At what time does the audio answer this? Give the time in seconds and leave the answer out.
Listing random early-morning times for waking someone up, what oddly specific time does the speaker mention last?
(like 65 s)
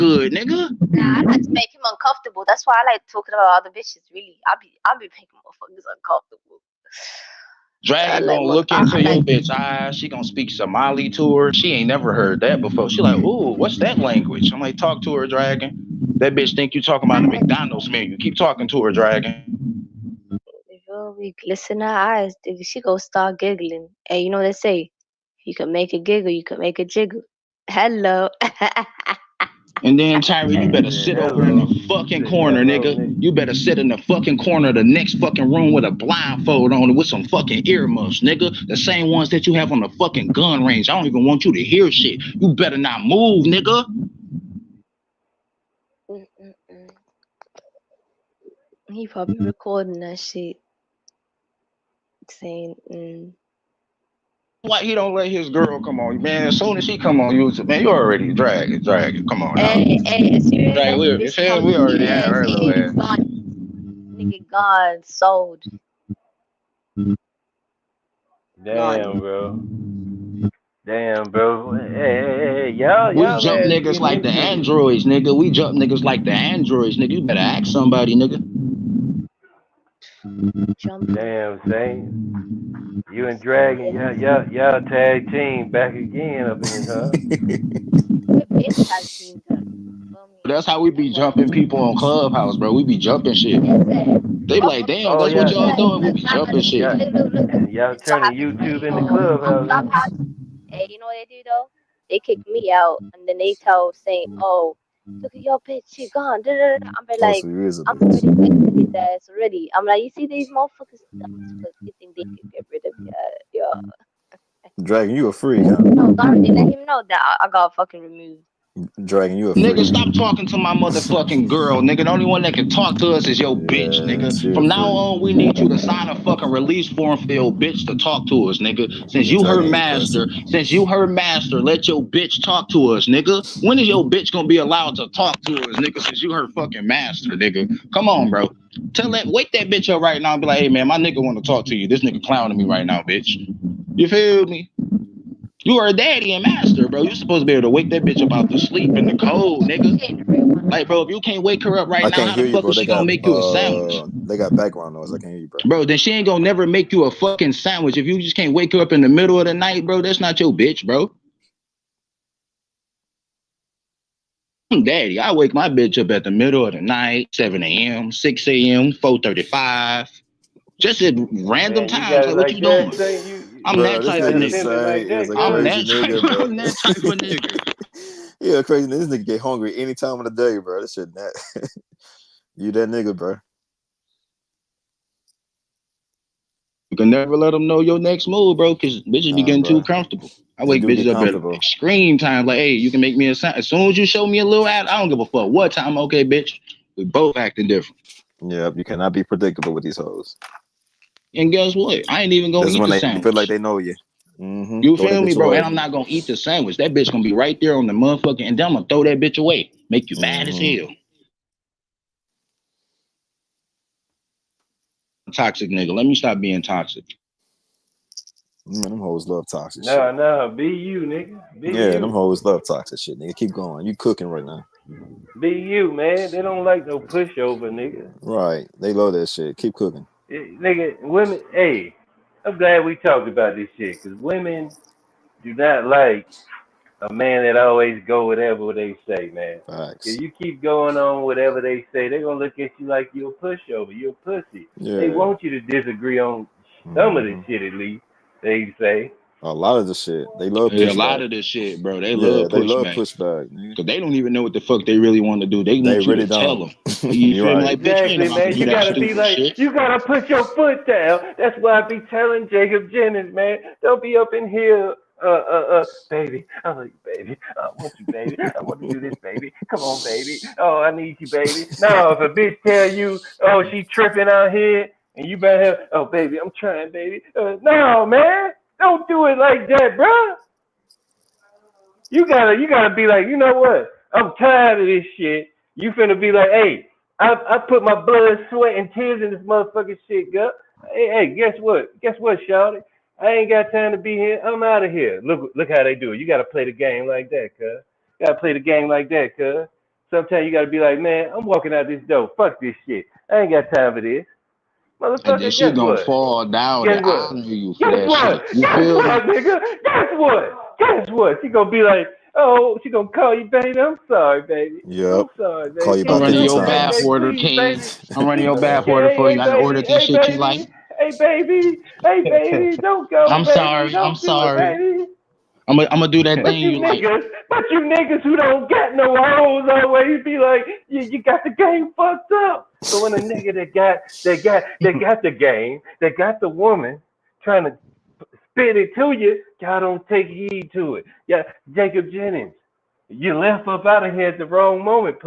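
168 s.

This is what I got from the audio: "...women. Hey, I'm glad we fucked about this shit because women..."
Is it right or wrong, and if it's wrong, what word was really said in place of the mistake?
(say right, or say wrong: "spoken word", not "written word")
wrong: "talked", not "fucked".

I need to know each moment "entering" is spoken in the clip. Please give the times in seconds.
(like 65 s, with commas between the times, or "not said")
not said.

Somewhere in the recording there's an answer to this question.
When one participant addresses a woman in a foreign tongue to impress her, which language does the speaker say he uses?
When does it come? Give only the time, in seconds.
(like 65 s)
10 s.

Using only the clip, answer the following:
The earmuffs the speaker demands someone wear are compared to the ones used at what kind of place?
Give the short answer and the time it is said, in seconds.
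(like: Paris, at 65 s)
gun range, at 40 s.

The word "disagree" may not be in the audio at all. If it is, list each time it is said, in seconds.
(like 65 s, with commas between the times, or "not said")
245 s.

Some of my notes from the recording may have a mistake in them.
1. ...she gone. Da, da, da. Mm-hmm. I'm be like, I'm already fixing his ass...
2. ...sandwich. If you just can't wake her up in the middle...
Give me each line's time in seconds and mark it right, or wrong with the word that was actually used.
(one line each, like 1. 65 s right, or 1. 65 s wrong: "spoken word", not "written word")
1. 105 s right
2. 157 s right.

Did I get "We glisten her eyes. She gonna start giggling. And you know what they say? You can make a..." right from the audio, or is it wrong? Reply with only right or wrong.
right.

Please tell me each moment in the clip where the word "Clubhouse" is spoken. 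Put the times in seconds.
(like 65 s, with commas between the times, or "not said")
91 s, 99 s.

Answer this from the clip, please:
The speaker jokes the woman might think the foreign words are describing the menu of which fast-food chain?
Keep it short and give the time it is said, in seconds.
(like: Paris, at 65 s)
McDonald's, at 17 s.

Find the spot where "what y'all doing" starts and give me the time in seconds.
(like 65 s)
95 s.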